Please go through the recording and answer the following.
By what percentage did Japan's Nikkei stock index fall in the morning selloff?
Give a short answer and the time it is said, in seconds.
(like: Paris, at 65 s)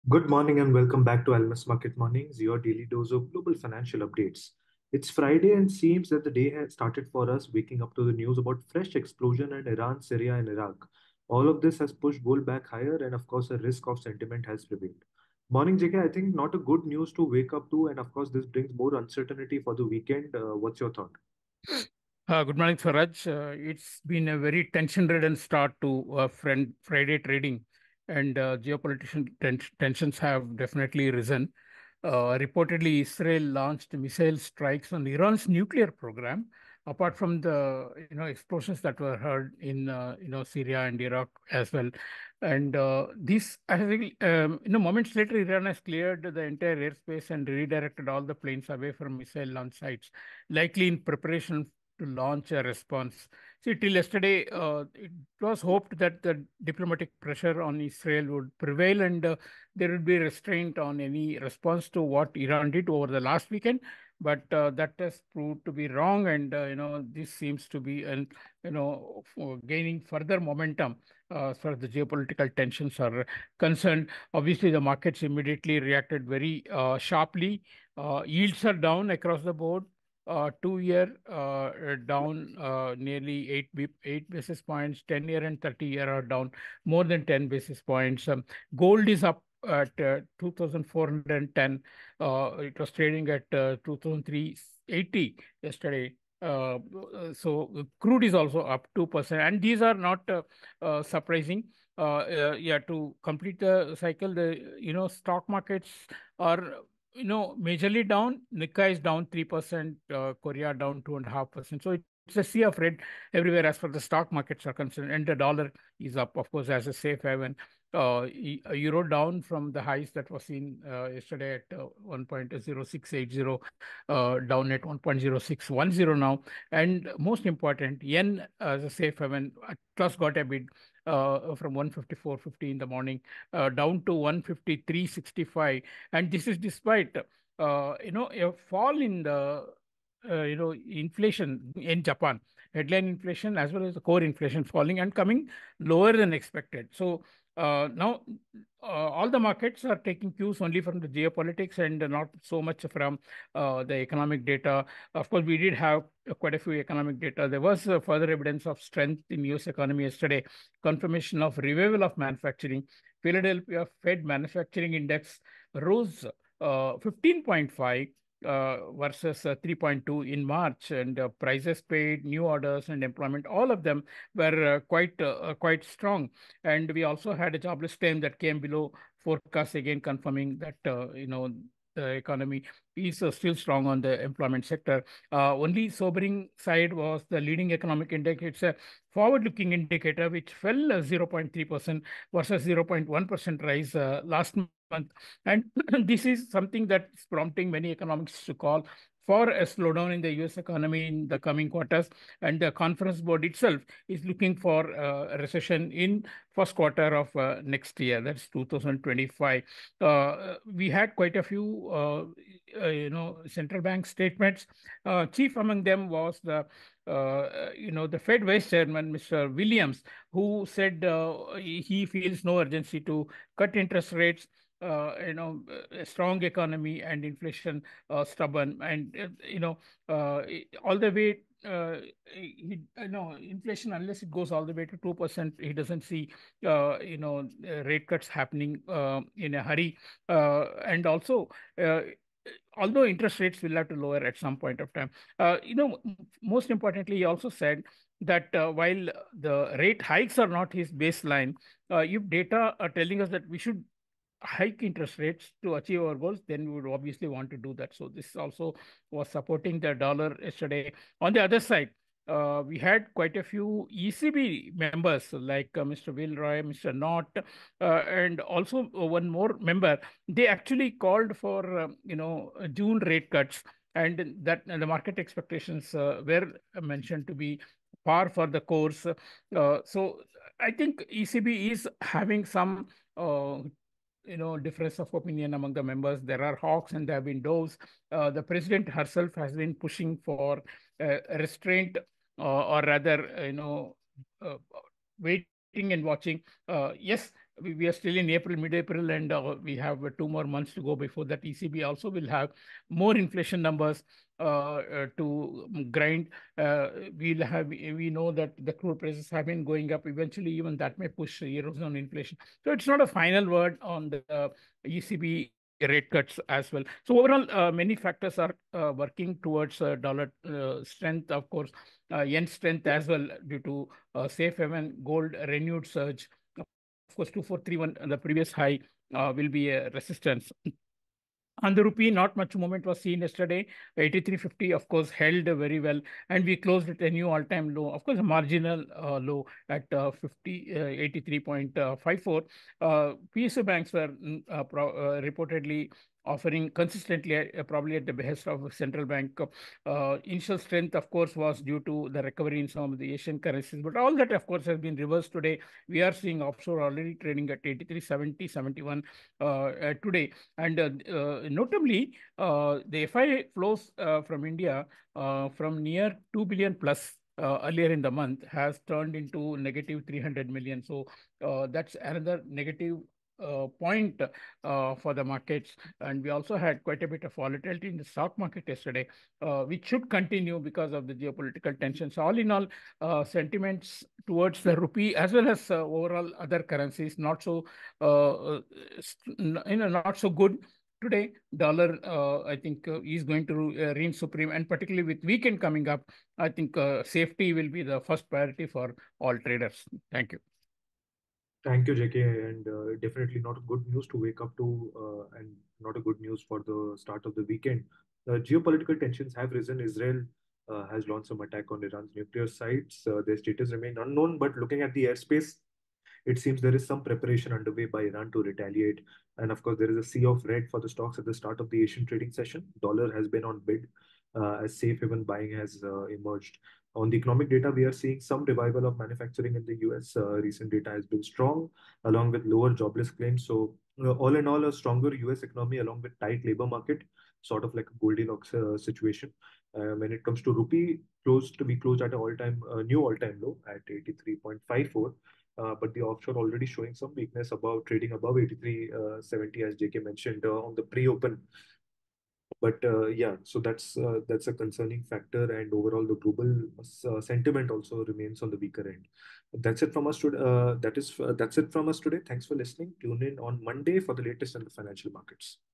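3%, at 109 s.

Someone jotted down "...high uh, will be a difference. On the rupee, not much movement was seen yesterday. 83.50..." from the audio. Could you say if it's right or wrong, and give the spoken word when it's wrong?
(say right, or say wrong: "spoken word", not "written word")
wrong: "resistance", not "difference".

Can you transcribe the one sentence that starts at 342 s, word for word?
Uh, uh, PSU banks were mm, uh, reportedly offering consistently uh, probably at the behest of central bank.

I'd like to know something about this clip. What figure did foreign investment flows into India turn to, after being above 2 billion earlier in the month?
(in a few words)
negative 300 million.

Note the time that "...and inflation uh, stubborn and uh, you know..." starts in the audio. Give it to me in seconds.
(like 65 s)
227 s.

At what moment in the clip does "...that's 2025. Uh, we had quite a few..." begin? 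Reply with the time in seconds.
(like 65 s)
208 s.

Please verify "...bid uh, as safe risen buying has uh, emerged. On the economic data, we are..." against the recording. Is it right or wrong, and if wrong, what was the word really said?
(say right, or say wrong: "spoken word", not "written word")
wrong: "haven", not "risen".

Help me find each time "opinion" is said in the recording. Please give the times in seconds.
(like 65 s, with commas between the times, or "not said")
285 s.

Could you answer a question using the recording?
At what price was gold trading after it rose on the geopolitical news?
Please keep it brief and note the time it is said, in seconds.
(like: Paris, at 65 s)
2,410, at 90 s.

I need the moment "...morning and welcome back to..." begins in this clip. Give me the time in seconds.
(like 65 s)
0 s.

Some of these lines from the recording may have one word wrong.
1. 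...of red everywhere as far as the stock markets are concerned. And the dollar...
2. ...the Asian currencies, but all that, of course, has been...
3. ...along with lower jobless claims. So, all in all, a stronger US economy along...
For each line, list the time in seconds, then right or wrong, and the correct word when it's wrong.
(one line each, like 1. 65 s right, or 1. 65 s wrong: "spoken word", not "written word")
1. 112 s right
2. 352 s right
3. 432 s right.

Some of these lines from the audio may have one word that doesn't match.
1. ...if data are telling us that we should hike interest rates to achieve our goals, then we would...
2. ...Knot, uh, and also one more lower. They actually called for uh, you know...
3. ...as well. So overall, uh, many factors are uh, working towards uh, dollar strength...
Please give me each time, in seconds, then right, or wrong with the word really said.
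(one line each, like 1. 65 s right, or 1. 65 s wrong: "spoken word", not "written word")
1. 251 s right
2. 266 s wrong: "member", not "lower"
3. 316 s right.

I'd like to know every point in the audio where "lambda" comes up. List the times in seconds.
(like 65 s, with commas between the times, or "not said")
not said.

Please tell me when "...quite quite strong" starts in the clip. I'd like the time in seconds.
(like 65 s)
174 s.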